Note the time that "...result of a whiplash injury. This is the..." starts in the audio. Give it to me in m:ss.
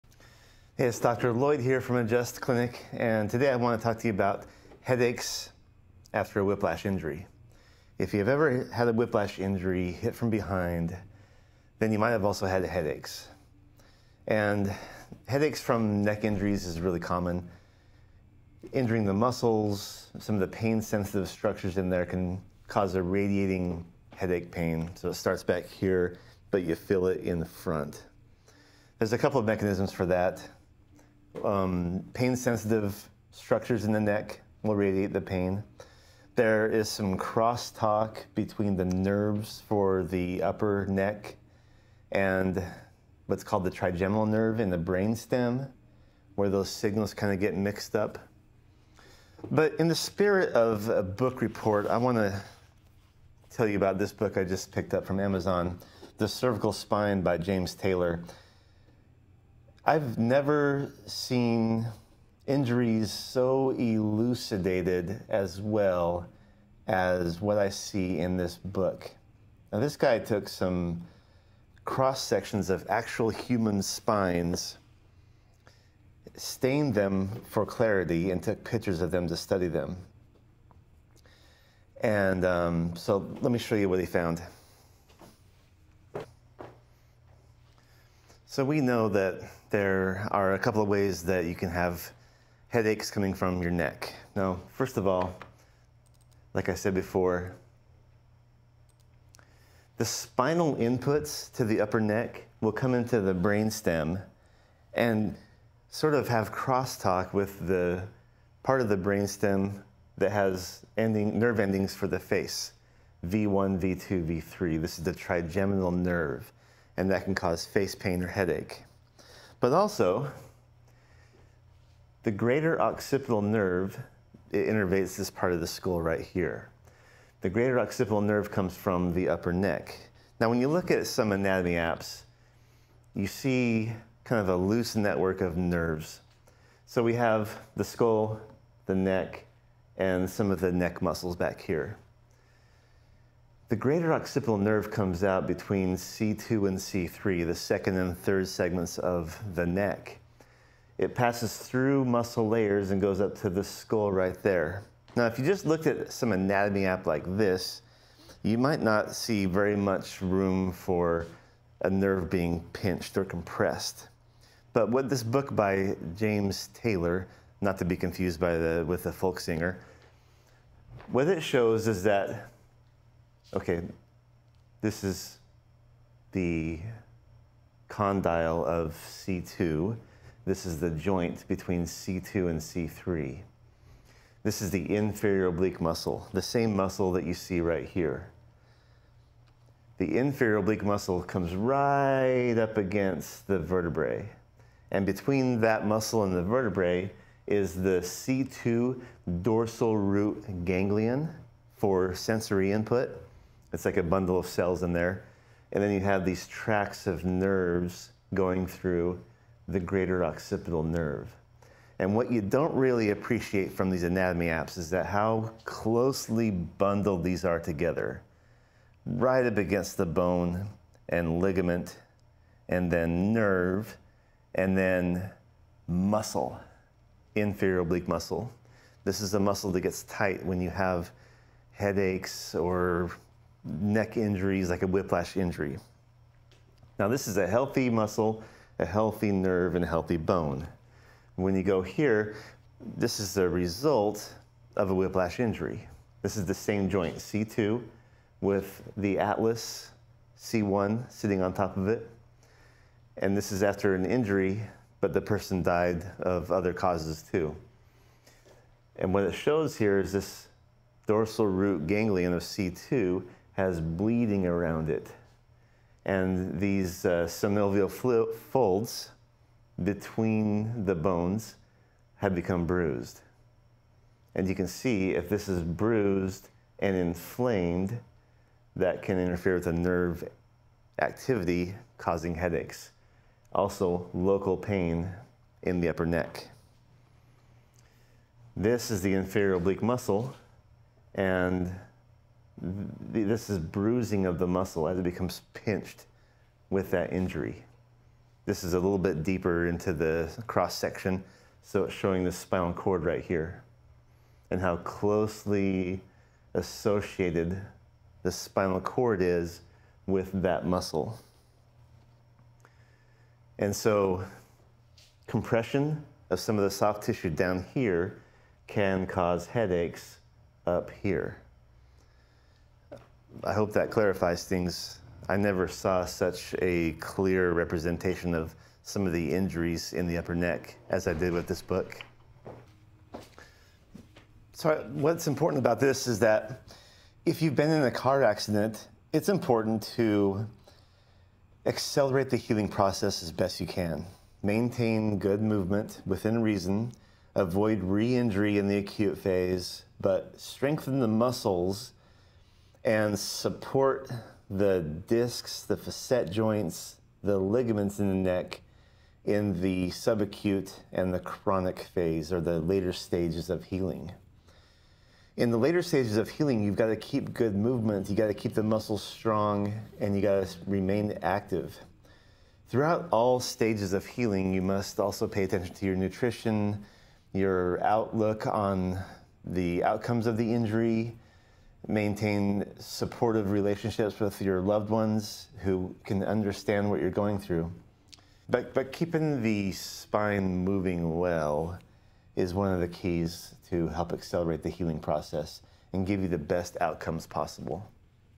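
4:03.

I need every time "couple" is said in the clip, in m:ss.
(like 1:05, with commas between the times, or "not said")
0:29, 1:30.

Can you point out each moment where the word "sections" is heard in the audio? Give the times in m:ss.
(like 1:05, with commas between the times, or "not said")
1:12, 5:00.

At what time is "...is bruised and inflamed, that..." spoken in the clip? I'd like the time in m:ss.
4:35.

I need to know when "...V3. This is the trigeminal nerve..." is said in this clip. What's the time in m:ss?
1:54.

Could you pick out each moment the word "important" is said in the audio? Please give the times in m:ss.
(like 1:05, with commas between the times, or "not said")
5:35, 5:39.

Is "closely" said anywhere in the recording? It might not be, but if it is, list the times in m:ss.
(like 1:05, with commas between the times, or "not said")
3:35, 5:04.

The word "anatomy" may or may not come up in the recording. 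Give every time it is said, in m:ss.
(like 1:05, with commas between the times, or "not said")
2:11, 2:36, 3:34.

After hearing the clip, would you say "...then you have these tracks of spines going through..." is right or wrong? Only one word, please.
wrong.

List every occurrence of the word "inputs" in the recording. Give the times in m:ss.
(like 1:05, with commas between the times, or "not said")
1:40, 3:22.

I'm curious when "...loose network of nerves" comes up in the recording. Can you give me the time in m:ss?
2:14.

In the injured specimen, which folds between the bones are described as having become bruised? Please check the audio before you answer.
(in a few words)
synovial folds.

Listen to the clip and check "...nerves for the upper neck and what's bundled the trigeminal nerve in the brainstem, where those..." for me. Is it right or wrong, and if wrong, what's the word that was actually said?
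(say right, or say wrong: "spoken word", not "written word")
wrong: "called", not "bundled".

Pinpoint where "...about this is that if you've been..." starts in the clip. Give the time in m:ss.
5:35.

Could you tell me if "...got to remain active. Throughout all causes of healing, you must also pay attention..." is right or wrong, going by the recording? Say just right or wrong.
wrong.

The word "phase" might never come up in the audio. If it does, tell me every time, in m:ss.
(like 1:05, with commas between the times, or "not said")
5:49, 6:01.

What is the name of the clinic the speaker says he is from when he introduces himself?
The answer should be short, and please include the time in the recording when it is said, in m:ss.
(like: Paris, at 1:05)
Adjust Clinic, at 0:01.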